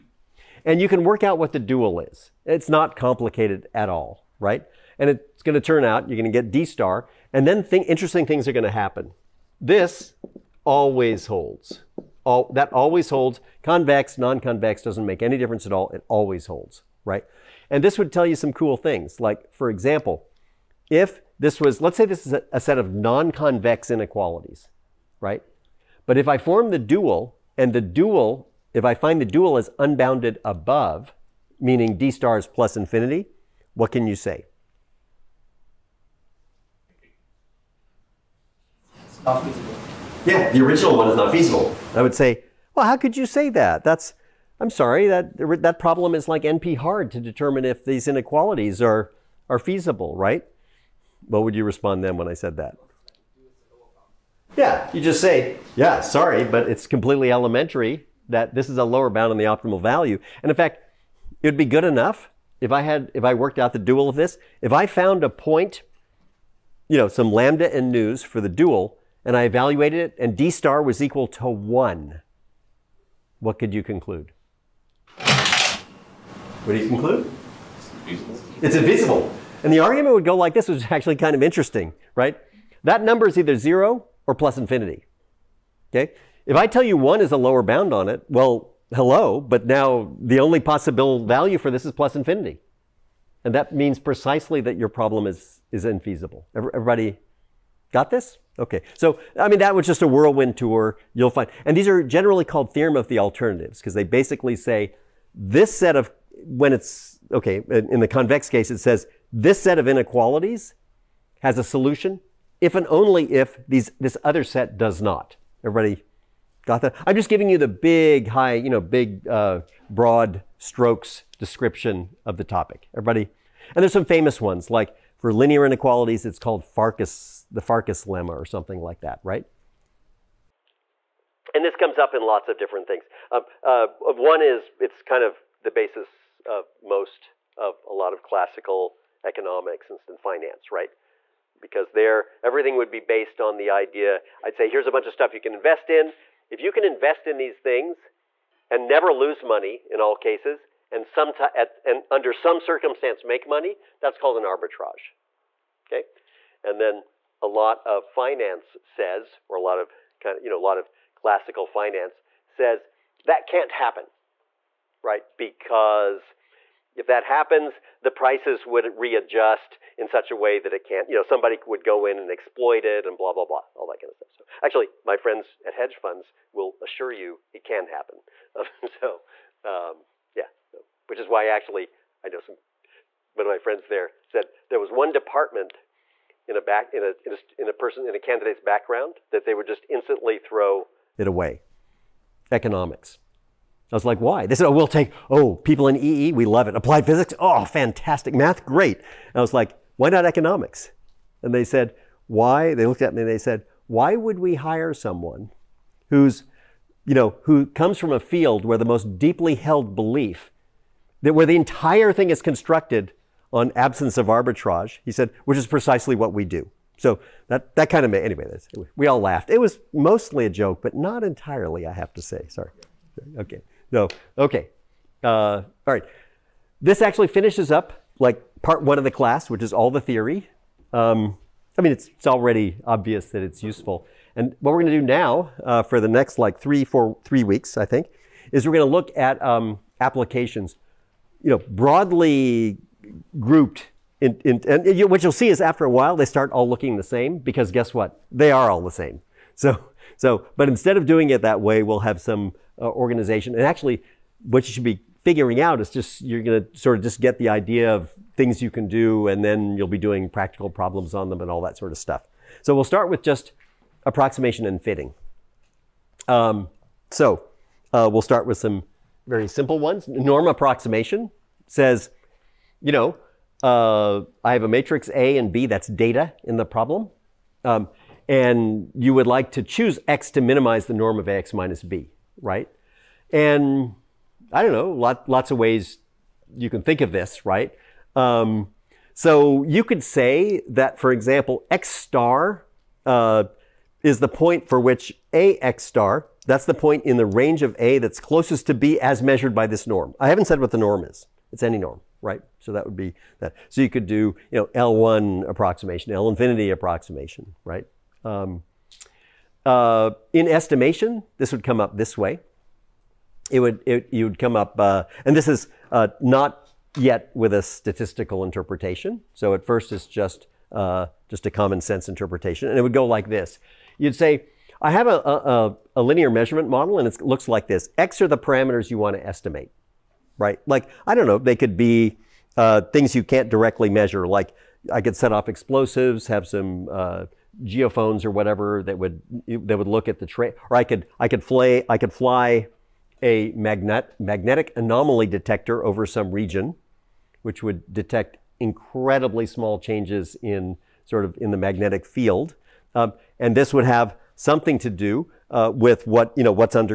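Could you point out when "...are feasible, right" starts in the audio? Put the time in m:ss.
0:49.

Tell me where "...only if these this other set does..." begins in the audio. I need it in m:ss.
1:52.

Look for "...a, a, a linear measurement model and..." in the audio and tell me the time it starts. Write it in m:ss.
5:25.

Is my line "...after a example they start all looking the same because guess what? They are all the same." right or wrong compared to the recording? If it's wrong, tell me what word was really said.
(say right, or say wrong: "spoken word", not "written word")
wrong: "while", not "example".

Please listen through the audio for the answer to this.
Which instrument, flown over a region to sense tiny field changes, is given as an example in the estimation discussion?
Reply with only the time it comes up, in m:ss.
5:44.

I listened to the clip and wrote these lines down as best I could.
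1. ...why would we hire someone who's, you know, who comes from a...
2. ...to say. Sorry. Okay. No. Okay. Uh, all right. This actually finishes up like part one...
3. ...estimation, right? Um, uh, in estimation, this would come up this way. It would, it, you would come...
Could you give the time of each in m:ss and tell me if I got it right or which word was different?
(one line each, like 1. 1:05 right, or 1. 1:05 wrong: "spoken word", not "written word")
1. 3:23 right
2. 3:42 right
3. 5:06 wrong: "approximation", not "estimation".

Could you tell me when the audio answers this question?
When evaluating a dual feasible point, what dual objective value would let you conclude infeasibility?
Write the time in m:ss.
1:10.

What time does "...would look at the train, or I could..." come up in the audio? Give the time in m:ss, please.
5:39.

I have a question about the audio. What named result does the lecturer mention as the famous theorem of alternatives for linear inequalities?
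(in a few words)
Farkas lemma.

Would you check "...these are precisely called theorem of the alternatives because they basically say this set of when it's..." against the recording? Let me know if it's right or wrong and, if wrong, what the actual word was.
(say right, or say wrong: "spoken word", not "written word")
wrong: "generally", not "precisely".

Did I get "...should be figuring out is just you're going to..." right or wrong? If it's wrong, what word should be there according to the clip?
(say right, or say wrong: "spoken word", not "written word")
right.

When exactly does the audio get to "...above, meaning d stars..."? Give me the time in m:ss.
0:30.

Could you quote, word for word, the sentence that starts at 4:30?
Norm approximation says you know, uh, I have a matrix A and B, that's data in the problem.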